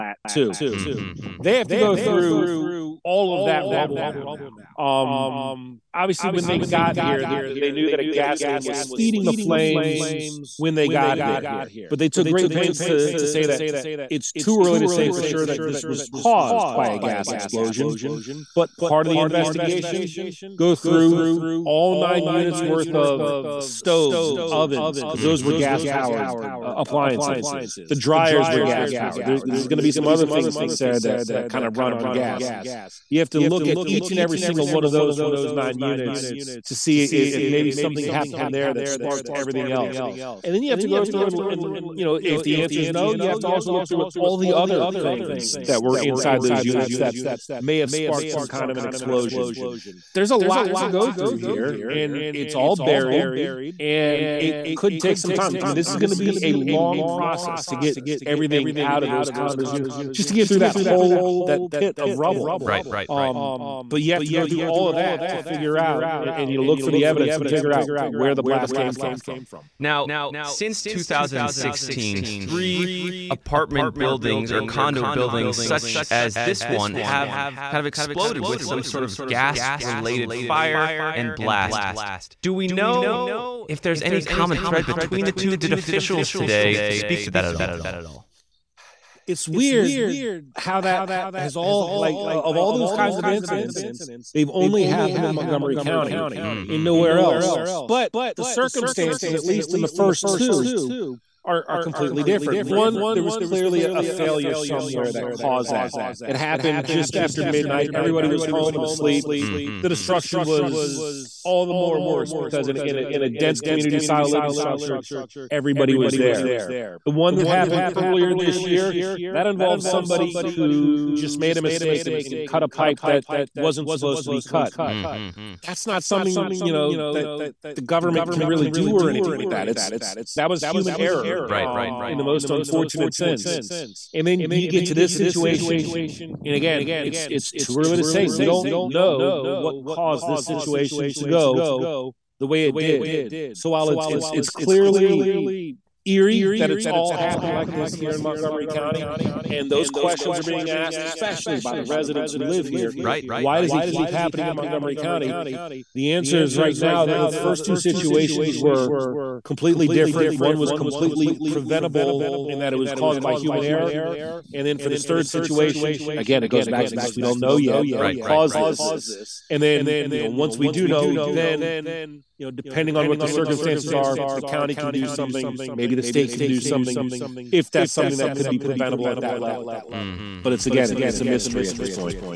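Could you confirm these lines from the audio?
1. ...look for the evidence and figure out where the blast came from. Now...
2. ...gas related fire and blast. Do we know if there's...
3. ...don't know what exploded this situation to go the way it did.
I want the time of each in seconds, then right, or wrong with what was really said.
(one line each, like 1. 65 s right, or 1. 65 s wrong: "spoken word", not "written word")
1. 66 s right
2. 79 s right
3. 138 s wrong: "caused", not "exploded".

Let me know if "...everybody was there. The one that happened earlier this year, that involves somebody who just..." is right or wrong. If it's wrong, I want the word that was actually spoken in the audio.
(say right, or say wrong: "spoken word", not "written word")
right.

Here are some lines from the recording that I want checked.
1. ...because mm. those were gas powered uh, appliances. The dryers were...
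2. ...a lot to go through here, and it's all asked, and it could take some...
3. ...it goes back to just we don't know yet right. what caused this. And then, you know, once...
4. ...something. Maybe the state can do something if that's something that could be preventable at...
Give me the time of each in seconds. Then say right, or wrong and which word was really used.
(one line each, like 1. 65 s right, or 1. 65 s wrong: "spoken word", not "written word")
1. 25 s right
2. 50 s wrong: "buried", not "asked"
3. 166 s right
4. 175 s right.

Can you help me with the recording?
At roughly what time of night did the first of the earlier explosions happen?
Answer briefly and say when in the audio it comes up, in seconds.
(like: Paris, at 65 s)
Just after midnight, at 106 s.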